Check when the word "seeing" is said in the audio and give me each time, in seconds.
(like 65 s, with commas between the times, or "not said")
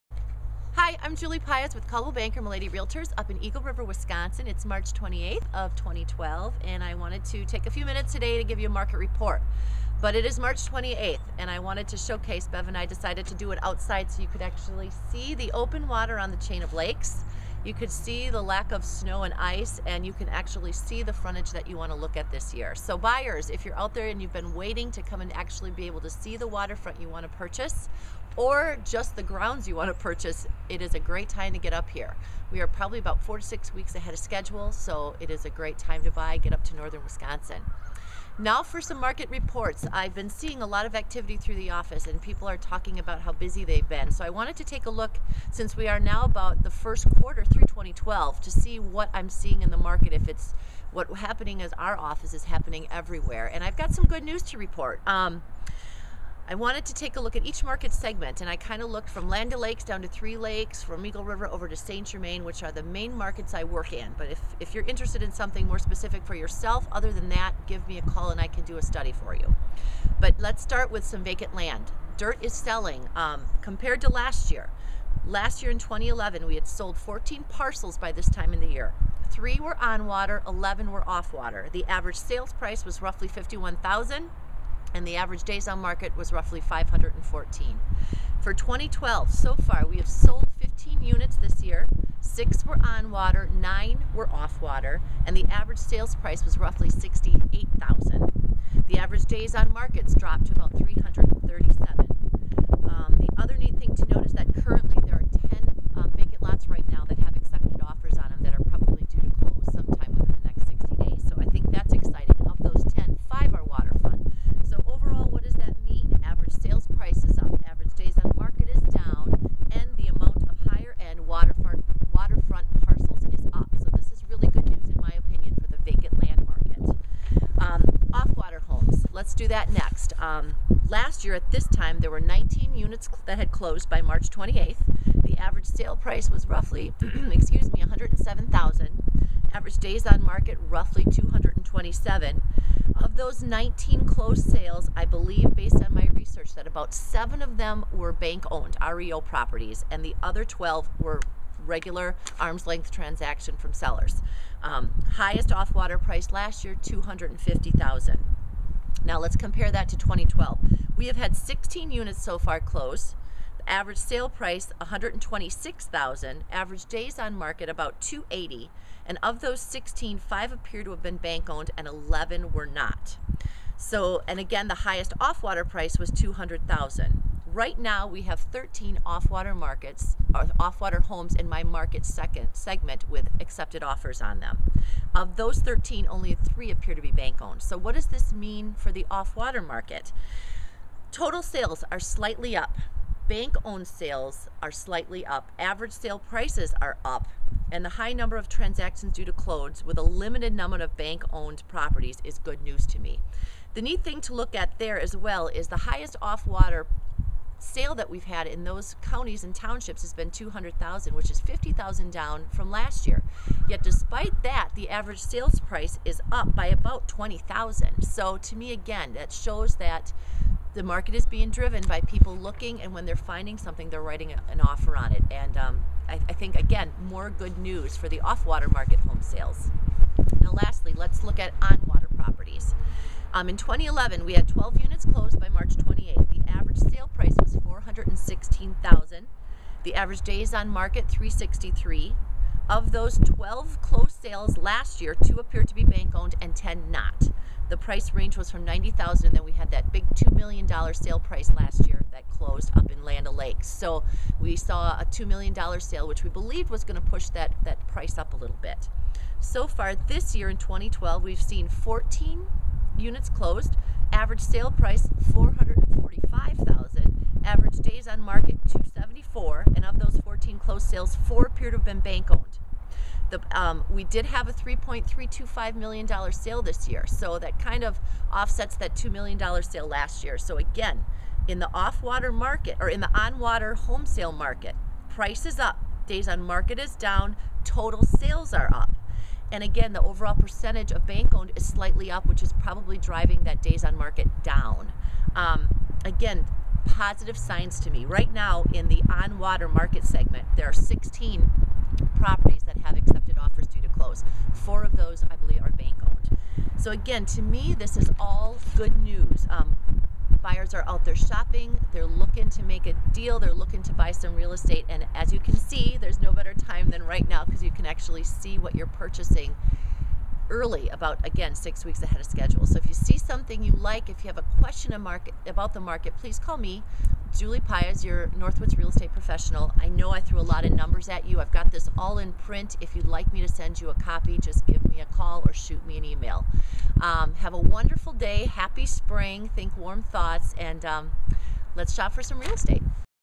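40 s, 49 s.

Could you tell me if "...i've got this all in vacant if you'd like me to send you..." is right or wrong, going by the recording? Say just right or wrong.
wrong.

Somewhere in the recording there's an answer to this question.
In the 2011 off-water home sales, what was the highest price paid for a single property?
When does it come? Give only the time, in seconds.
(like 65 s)
156 s.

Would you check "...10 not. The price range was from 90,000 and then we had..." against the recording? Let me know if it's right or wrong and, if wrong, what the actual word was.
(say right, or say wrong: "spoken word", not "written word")
right.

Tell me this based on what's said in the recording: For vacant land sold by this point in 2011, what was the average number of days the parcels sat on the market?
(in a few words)
514.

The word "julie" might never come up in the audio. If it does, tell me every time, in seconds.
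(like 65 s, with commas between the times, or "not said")
1 s, 327 s.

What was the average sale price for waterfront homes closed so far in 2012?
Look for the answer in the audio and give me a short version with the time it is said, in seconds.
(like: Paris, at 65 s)
445,000, at 265 s.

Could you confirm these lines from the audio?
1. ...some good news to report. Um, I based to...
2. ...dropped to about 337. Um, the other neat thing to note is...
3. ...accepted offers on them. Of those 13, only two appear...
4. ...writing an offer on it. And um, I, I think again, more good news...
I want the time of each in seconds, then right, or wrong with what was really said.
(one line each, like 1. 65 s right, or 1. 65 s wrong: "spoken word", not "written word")
1. 53 s wrong: "wanted", not "based"
2. 100 s right
3. 183 s wrong: "three", not "two"
4. 224 s right.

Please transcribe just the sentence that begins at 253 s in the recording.
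So we saw a $2 million sale, which we believed was going to push that, that price up a little bit.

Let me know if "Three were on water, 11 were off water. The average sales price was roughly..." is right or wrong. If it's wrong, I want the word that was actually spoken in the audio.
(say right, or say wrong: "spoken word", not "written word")
right.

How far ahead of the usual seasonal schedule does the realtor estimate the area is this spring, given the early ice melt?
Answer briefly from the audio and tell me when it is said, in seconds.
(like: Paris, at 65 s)
4 to 6 weeks, at 33 s.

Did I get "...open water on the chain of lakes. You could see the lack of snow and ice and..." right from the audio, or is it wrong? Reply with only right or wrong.
right.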